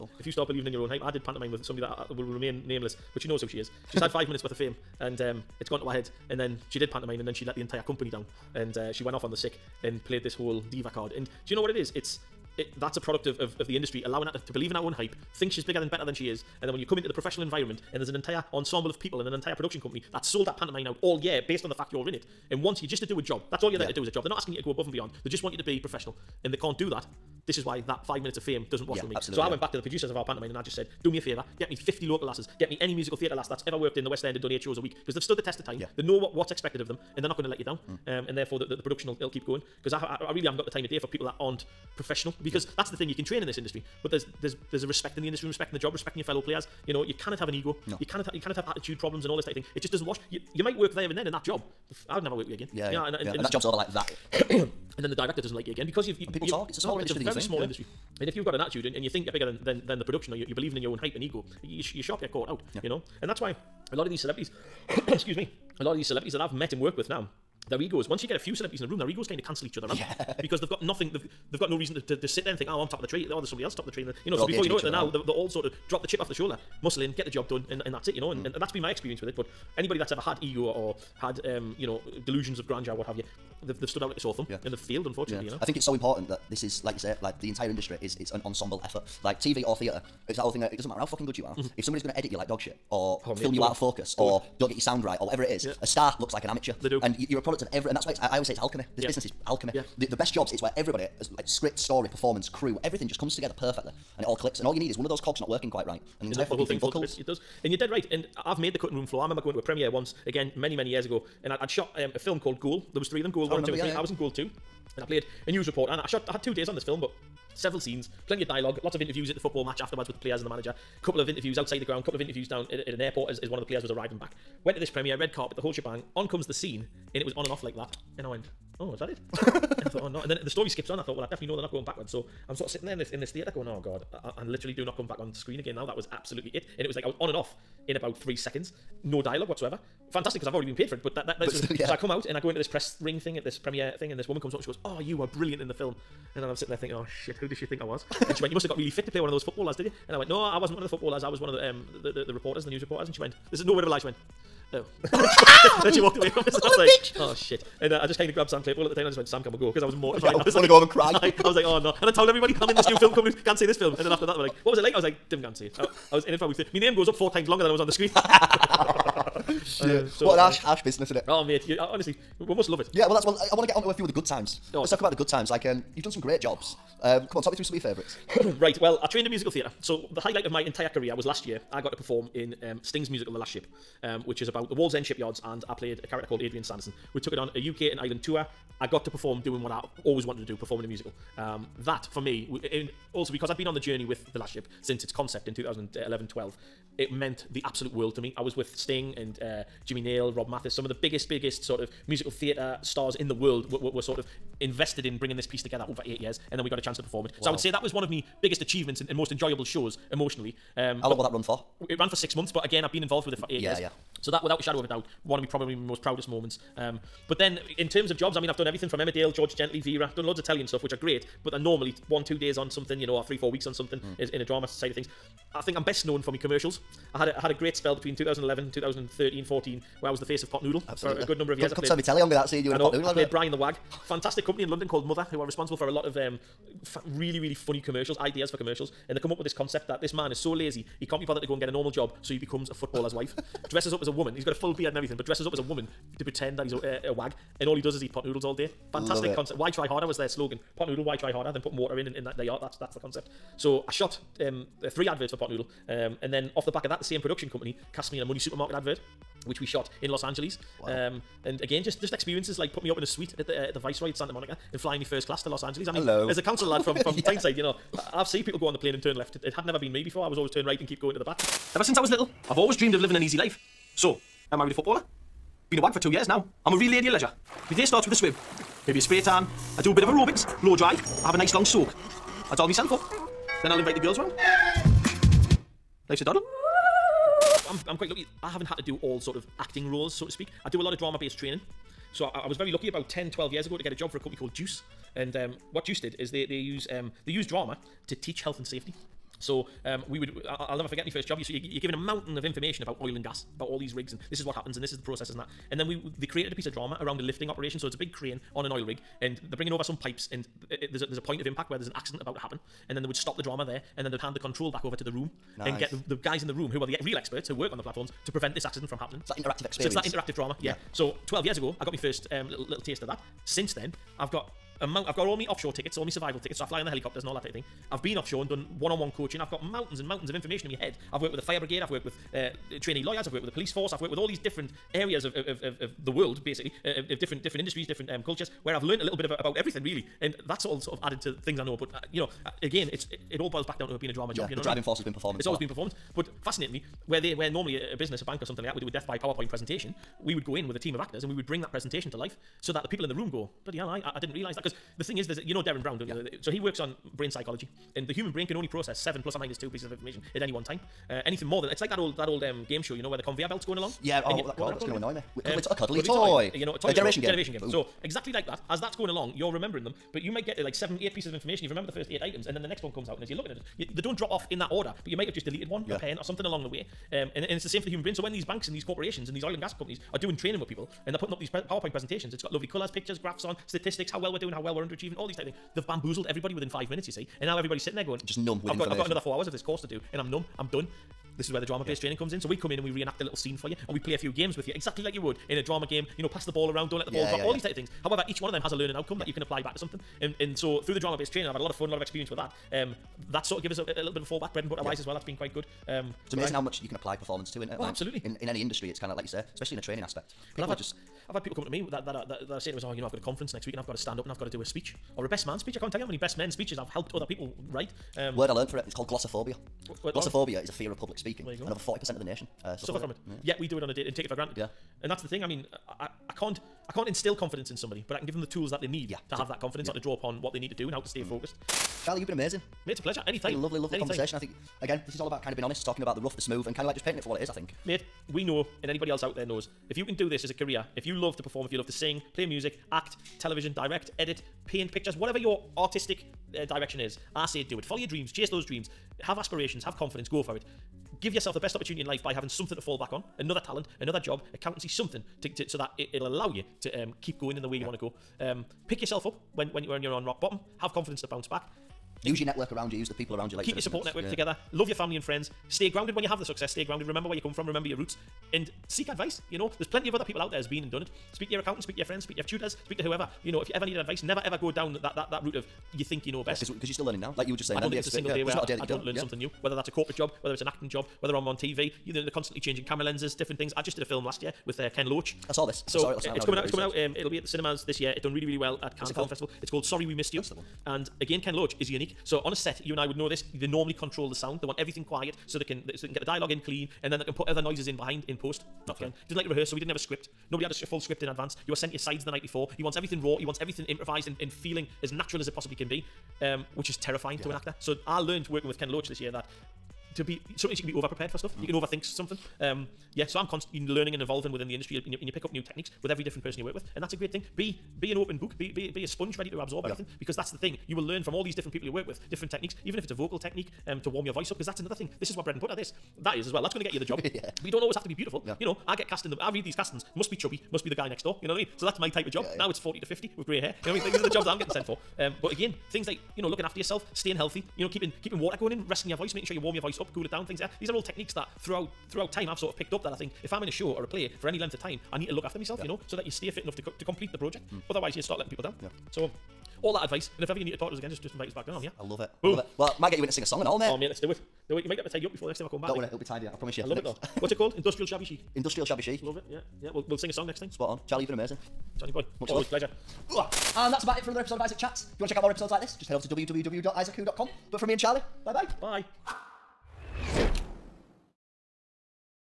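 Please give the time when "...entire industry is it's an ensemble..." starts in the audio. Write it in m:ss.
1:27.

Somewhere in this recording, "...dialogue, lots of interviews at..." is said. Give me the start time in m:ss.
1:58.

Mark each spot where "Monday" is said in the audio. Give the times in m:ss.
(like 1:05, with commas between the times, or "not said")
not said.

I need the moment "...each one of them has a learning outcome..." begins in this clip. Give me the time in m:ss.
6:38.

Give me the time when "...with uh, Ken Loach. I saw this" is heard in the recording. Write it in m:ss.
8:04.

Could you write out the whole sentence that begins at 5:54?
Because the thing is, there's a, you know Derren Brown, don't yeah.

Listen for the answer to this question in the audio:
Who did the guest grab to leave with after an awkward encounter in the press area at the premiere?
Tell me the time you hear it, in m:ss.
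2:38.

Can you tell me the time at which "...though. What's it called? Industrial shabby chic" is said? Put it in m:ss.
9:17.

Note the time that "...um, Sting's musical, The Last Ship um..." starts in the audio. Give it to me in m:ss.
3:02.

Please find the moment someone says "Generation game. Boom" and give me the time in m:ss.
6:07.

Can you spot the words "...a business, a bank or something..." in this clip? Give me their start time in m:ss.
5:47.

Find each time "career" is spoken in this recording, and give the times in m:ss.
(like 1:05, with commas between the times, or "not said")
3:00, 7:20.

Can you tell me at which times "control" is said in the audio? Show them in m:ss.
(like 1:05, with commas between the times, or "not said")
5:14, 8:13.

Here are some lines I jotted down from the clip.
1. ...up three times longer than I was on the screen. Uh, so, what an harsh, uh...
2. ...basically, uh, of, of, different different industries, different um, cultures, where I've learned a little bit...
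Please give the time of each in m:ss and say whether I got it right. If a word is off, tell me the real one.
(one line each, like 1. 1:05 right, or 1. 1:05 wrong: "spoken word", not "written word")
1. 2:47 wrong: "four", not "three"
2. 5:36 right.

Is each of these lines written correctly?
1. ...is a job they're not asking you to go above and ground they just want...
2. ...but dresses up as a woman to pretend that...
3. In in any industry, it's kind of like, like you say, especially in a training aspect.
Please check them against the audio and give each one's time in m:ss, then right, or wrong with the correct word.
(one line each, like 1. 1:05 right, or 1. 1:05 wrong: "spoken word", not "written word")
1. 0:24 wrong: "beyond", not "ground"
2. 4:05 right
3. 6:48 right.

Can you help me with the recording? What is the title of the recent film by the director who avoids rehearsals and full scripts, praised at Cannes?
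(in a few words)
Sorry We Missed You.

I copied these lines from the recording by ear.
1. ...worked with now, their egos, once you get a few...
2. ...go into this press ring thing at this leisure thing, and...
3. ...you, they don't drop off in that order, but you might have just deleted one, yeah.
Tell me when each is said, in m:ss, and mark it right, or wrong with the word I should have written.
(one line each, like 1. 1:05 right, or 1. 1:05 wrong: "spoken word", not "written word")
1. 1:06 right
2. 2:22 wrong: "premiere", not "leisure"
3. 6:13 right.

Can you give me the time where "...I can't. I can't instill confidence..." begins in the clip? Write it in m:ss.
7:06.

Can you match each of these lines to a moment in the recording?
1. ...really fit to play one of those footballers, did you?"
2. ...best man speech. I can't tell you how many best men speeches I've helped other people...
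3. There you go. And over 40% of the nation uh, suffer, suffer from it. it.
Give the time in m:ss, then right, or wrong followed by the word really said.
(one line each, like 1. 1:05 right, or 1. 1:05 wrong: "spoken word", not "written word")
1. 2:28 right
2. 6:55 right
3. 7:01 right.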